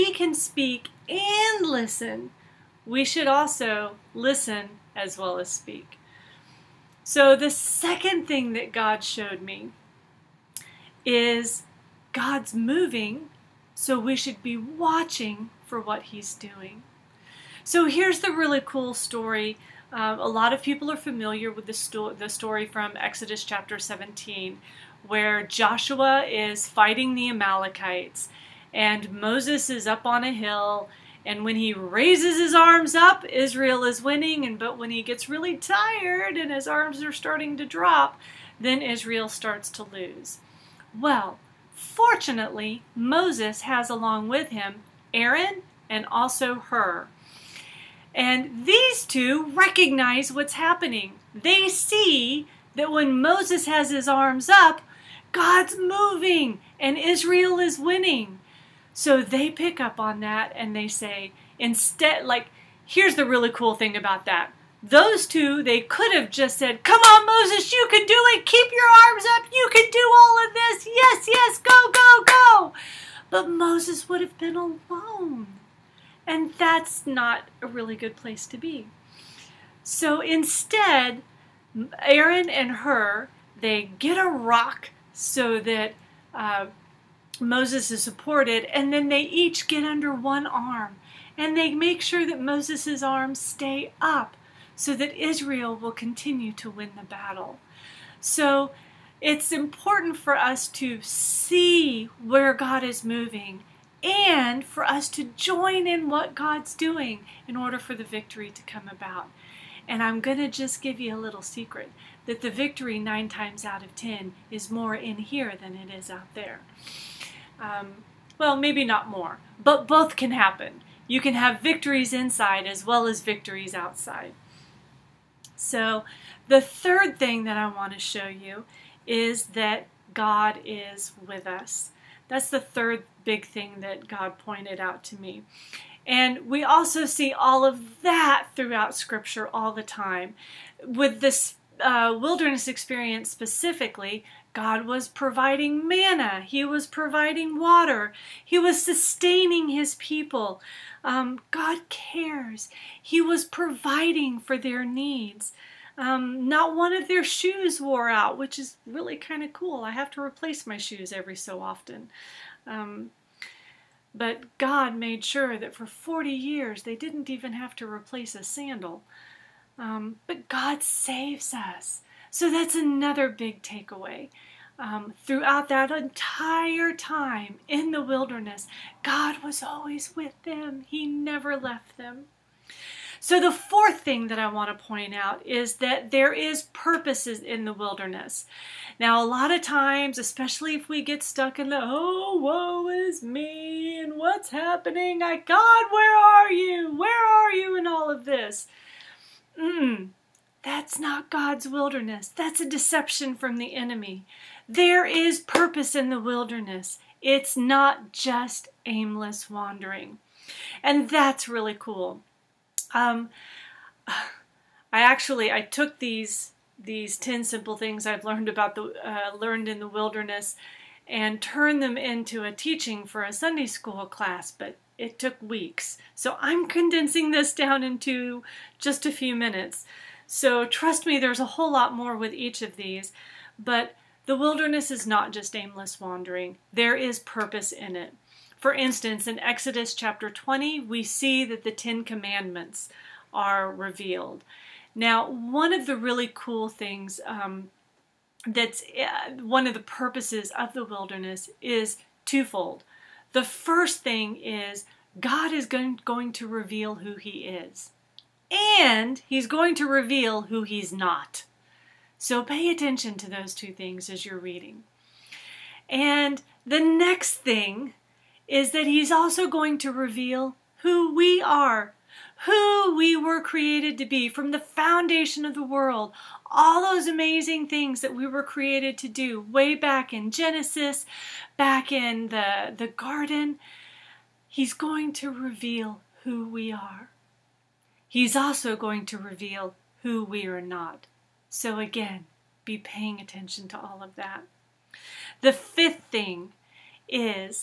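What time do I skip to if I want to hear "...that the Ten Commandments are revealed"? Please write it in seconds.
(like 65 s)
241 s.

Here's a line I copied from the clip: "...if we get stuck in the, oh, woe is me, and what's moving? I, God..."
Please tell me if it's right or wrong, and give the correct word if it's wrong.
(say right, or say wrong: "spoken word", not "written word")
wrong: "happening", not "moving".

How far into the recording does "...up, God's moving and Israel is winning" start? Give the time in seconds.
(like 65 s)
54 s.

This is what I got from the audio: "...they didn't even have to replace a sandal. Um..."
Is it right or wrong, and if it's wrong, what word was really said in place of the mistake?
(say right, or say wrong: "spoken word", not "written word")
right.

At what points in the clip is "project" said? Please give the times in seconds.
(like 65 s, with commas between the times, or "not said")
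not said.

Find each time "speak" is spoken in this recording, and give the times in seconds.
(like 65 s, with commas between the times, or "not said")
0 s, 5 s.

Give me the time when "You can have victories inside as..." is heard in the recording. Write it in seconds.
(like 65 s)
121 s.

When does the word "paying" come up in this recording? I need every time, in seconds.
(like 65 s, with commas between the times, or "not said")
292 s.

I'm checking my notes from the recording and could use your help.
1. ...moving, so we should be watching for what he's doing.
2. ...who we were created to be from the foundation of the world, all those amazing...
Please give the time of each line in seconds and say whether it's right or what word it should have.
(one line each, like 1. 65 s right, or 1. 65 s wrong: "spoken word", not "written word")
1. 12 s right
2. 272 s right.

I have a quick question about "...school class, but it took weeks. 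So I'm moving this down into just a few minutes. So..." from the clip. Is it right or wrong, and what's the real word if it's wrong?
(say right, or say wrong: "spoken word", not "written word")
wrong: "condensing", not "moving".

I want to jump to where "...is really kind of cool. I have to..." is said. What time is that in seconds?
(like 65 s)
158 s.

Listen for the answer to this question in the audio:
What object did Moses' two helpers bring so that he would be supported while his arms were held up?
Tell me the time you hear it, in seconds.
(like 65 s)
84 s.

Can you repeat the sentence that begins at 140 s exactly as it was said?
With this uh, wilderness experience specifically, God was providing manna, He was providing water, He was sustaining His people.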